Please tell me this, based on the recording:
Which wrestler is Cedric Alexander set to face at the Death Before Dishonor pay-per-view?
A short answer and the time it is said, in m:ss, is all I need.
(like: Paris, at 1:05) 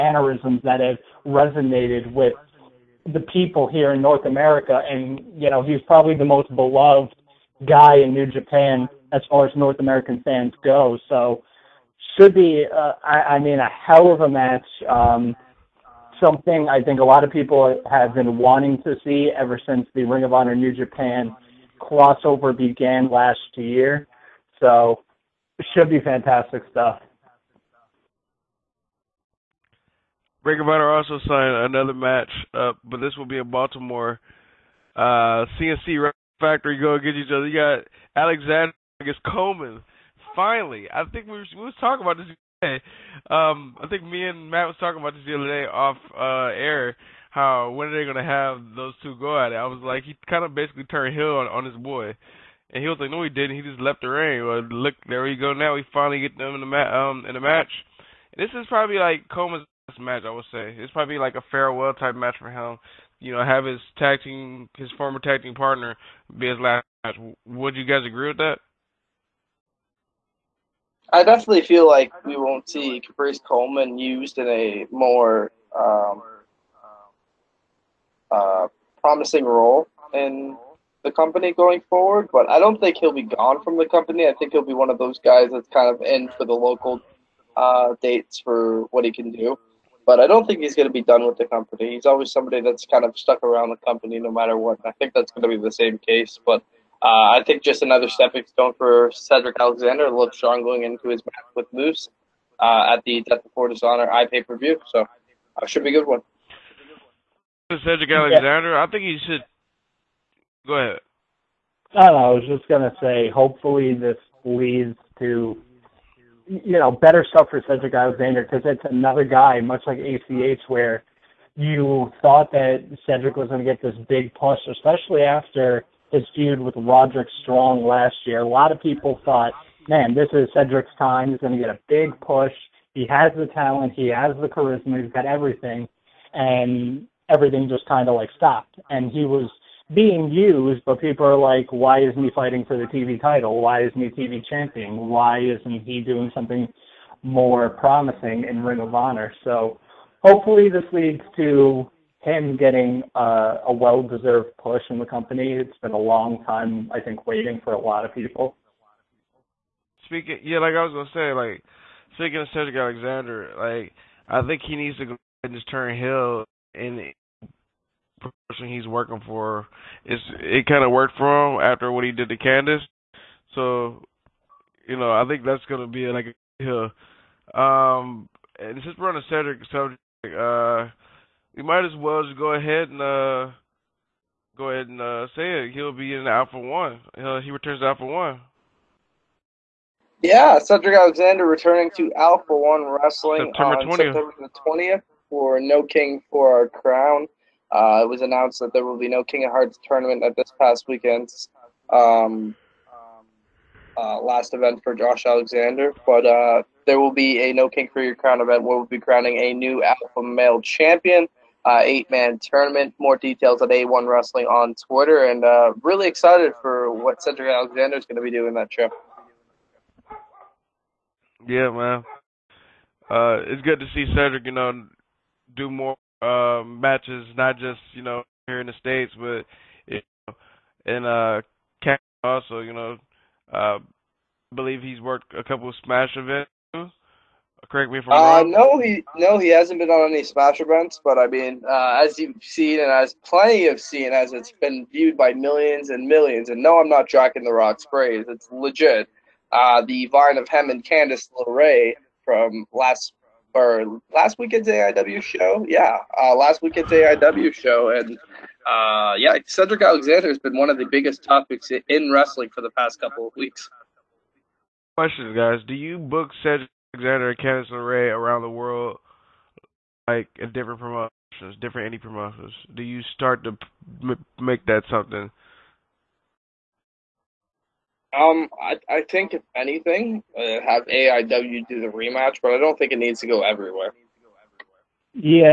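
Moose, at 1:41.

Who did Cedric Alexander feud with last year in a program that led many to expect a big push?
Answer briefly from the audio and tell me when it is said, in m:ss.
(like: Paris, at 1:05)
Roderick Strong, at 2:06.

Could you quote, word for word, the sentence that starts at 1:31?
He's always somebody that's kind of stuck around the company no matter what.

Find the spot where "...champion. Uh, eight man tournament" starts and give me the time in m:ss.
3:30.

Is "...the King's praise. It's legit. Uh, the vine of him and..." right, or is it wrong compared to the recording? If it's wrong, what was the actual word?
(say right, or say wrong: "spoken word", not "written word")
wrong: "Rock", not "King".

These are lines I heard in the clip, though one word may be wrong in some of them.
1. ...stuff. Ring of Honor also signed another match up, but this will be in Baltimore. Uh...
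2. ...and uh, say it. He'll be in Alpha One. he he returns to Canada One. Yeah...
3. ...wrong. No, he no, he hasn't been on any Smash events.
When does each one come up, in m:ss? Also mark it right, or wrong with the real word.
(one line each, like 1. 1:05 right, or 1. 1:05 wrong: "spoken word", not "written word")
1. 0:26 right
2. 3:04 wrong: "Alpha", not "Canada"
3. 3:58 right.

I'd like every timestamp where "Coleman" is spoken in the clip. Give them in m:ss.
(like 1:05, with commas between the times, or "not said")
0:39, 0:59, 1:13.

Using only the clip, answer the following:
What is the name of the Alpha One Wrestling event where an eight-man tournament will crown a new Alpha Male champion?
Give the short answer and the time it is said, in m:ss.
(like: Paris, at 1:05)
No King for Your Crown, at 3:27.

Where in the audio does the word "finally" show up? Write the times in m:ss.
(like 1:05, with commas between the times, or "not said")
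0:40, 0:55.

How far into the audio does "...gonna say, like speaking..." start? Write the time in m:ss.
2:40.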